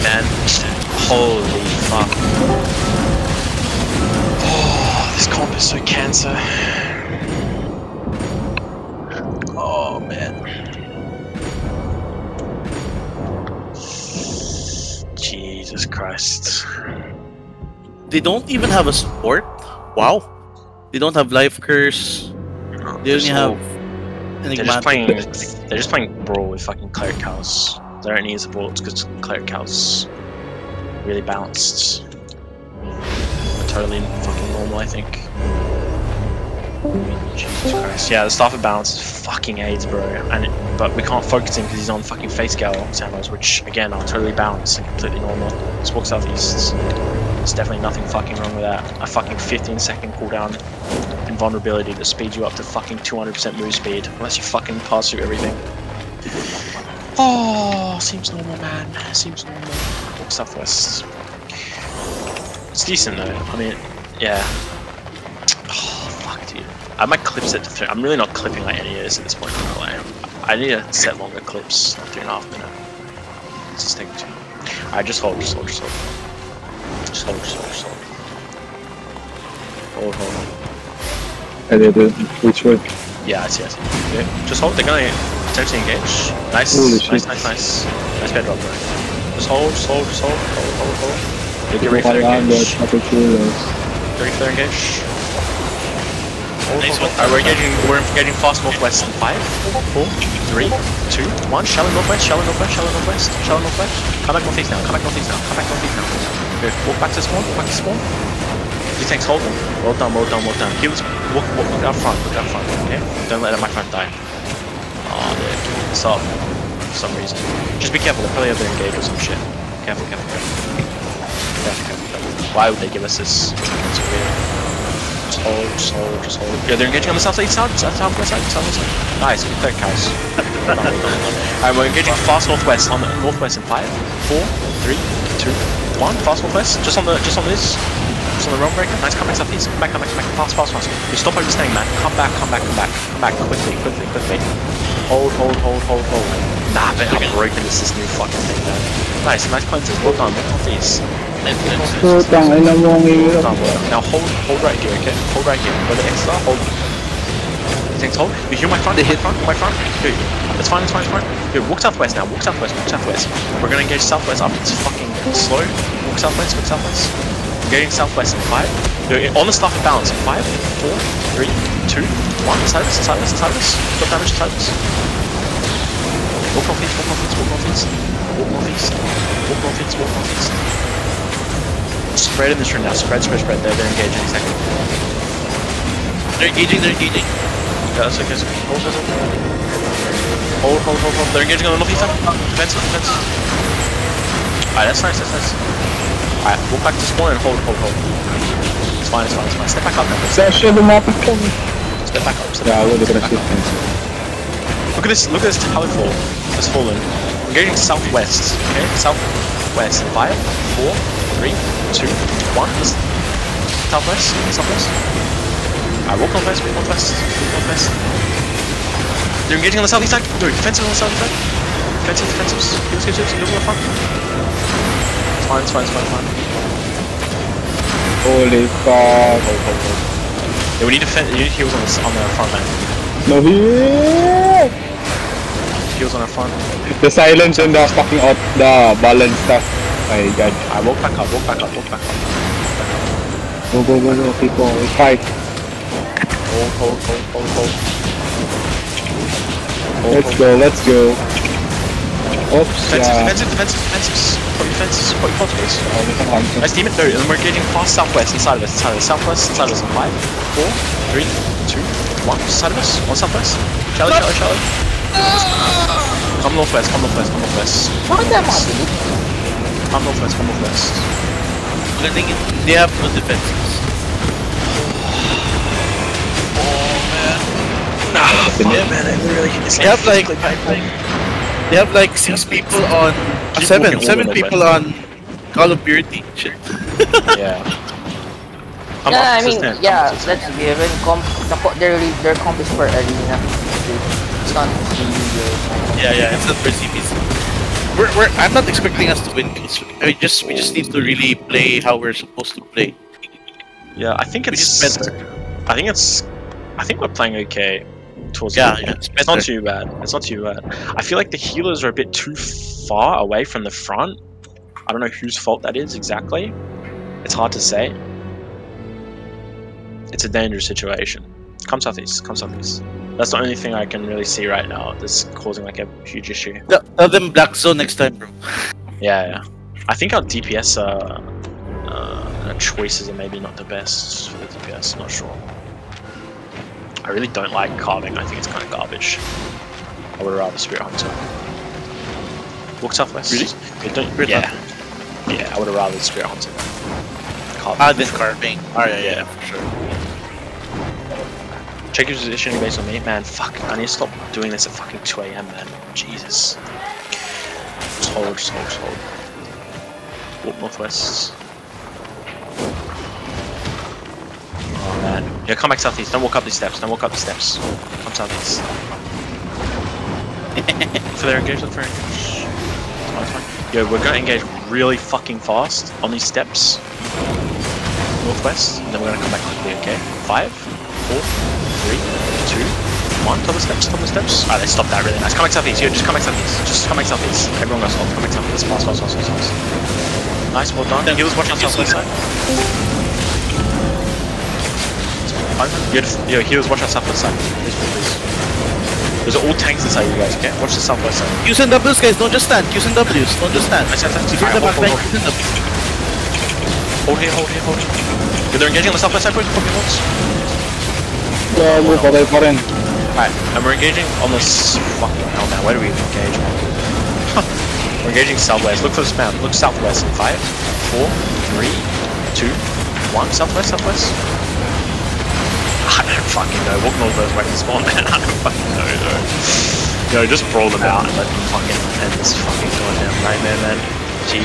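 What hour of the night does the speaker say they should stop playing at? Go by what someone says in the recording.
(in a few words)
2 a.m.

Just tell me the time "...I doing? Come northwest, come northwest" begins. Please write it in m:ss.
4:28.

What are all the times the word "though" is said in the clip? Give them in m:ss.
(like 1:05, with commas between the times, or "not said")
1:03, 7:09.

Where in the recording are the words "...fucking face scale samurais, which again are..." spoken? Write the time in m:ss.
0:42.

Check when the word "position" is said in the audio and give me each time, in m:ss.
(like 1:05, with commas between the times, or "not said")
5:52.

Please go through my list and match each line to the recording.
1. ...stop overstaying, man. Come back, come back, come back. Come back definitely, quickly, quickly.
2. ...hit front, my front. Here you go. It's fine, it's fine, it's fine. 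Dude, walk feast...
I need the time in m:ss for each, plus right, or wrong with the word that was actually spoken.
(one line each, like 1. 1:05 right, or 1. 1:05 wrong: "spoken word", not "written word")
1. 2:21 wrong: "quickly", not "definitely"
2. 2:39 wrong: "southwest", not "feast".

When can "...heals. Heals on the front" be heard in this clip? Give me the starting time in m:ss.
3:43.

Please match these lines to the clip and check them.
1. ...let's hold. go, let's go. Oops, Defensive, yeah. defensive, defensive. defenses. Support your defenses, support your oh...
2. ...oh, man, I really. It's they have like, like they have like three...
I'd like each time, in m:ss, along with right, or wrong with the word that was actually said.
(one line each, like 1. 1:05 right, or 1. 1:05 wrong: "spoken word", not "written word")
1. 4:10 right
2. 4:38 wrong: "six", not "three".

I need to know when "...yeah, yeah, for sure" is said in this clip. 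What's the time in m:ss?
5:48.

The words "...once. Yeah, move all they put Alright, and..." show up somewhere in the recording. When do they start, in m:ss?
6:49.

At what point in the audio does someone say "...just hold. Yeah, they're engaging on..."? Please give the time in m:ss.
2:06.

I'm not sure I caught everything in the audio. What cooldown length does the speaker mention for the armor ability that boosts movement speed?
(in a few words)
15 seconds.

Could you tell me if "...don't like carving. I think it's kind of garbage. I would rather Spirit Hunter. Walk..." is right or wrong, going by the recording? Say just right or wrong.
right.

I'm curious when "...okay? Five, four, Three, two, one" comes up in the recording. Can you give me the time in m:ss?
6:19.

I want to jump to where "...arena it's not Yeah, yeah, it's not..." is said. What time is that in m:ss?
4:52.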